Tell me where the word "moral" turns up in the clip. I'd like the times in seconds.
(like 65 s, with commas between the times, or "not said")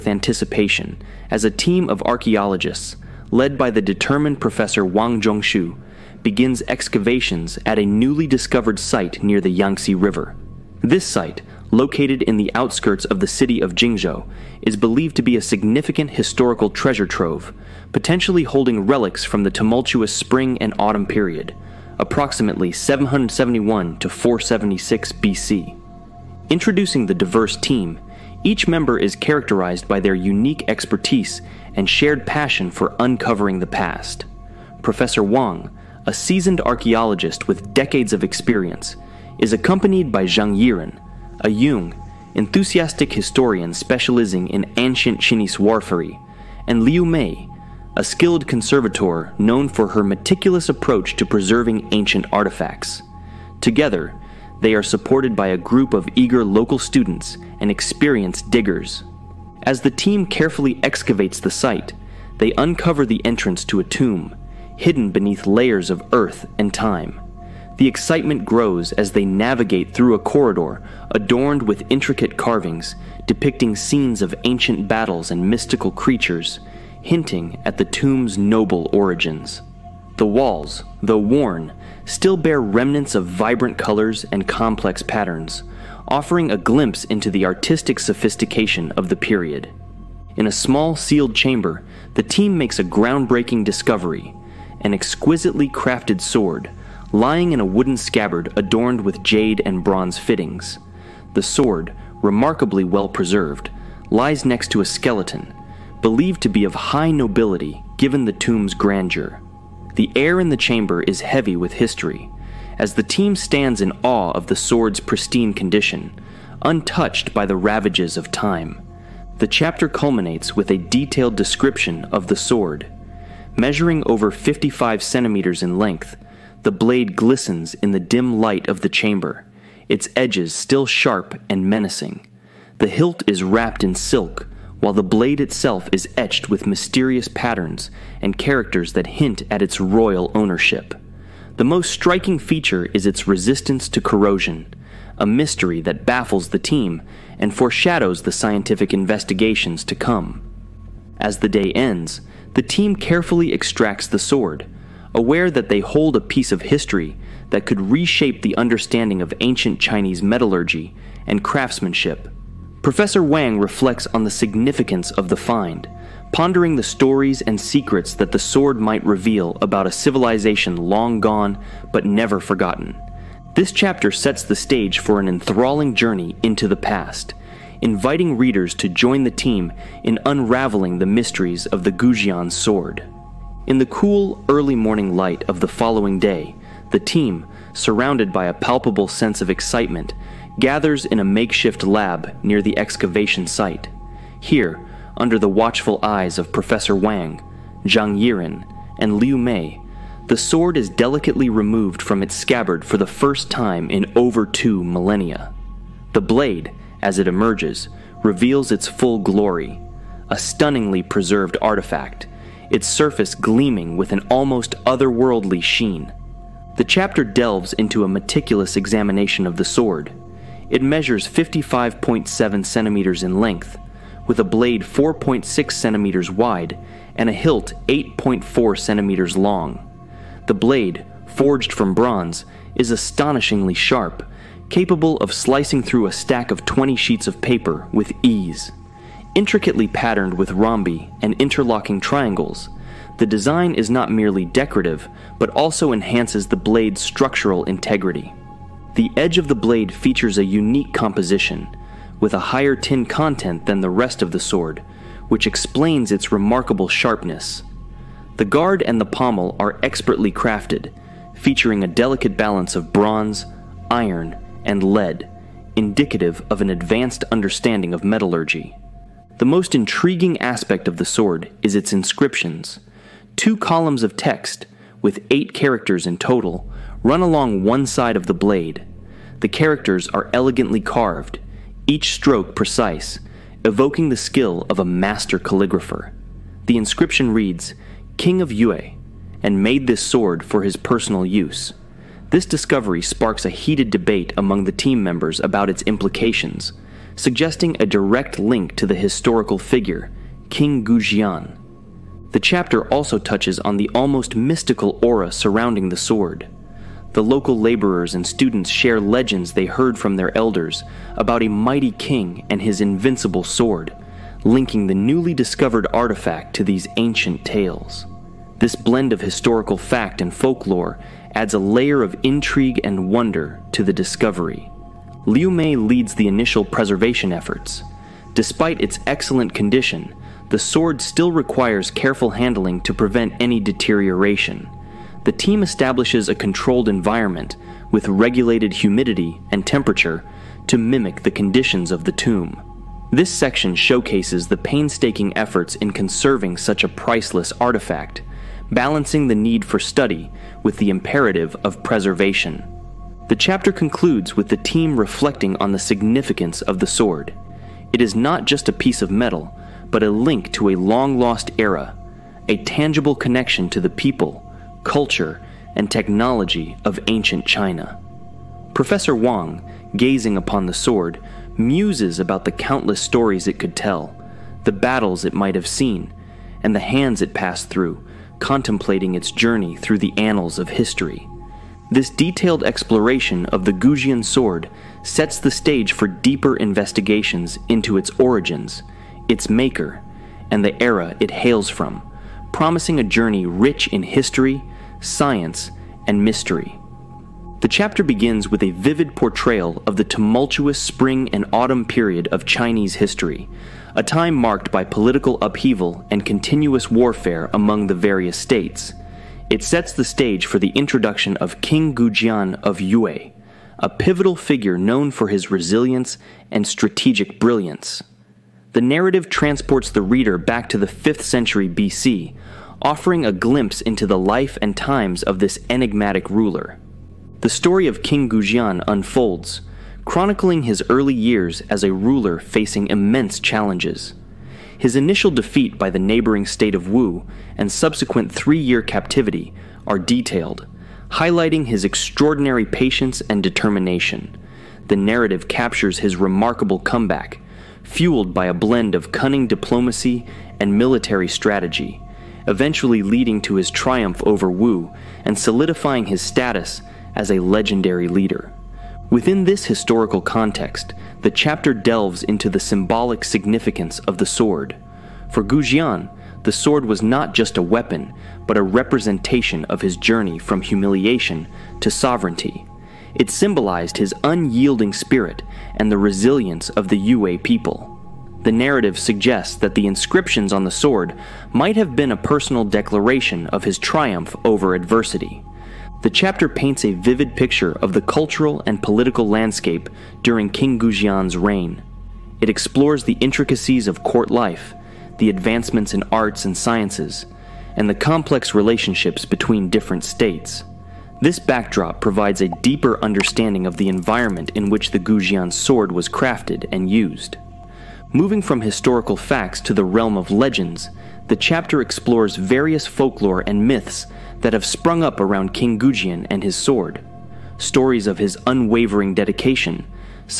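not said.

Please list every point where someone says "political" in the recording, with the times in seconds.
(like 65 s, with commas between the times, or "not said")
404 s, 488 s.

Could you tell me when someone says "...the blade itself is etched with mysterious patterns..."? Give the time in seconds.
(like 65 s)
134 s.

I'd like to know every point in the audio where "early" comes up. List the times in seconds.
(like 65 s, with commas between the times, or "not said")
184 s, 430 s.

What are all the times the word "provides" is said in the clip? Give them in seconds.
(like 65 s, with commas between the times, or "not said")
502 s.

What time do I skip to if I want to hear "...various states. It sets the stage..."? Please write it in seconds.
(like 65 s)
407 s.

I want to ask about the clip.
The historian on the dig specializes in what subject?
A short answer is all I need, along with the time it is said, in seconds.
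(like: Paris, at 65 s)
ancient Chinese warfare, at 44 s.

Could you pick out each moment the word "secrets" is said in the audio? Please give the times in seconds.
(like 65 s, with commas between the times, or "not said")
167 s.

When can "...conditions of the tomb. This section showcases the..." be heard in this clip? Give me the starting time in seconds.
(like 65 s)
341 s.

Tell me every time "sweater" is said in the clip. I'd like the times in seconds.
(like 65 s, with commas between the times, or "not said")
not said.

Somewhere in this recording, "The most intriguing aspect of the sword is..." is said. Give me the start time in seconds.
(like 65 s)
269 s.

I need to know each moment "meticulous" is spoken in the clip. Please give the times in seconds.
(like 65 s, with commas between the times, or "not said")
50 s, 218 s.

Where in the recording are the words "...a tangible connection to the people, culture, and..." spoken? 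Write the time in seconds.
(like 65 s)
362 s.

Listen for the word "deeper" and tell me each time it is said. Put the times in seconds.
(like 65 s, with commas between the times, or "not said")
386 s, 502 s.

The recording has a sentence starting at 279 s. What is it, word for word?
The characters are elegantly carved, each stroke precise, evoking the skill of a master calligrapher.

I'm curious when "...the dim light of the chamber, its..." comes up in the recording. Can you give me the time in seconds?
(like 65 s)
127 s.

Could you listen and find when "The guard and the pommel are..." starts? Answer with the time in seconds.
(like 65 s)
258 s.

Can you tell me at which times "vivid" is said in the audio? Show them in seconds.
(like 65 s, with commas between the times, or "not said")
398 s, 486 s.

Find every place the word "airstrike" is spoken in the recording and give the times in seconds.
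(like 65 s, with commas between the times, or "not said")
not said.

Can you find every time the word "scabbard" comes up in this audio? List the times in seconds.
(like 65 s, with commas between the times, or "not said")
97 s, 202 s.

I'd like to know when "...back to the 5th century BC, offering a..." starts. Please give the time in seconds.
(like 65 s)
420 s.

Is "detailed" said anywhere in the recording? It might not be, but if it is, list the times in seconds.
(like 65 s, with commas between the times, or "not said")
120 s, 382 s, 439 s.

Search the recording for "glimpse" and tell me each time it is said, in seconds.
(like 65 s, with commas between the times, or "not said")
86 s, 423 s.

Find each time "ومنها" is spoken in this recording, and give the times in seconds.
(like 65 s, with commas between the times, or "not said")
not said.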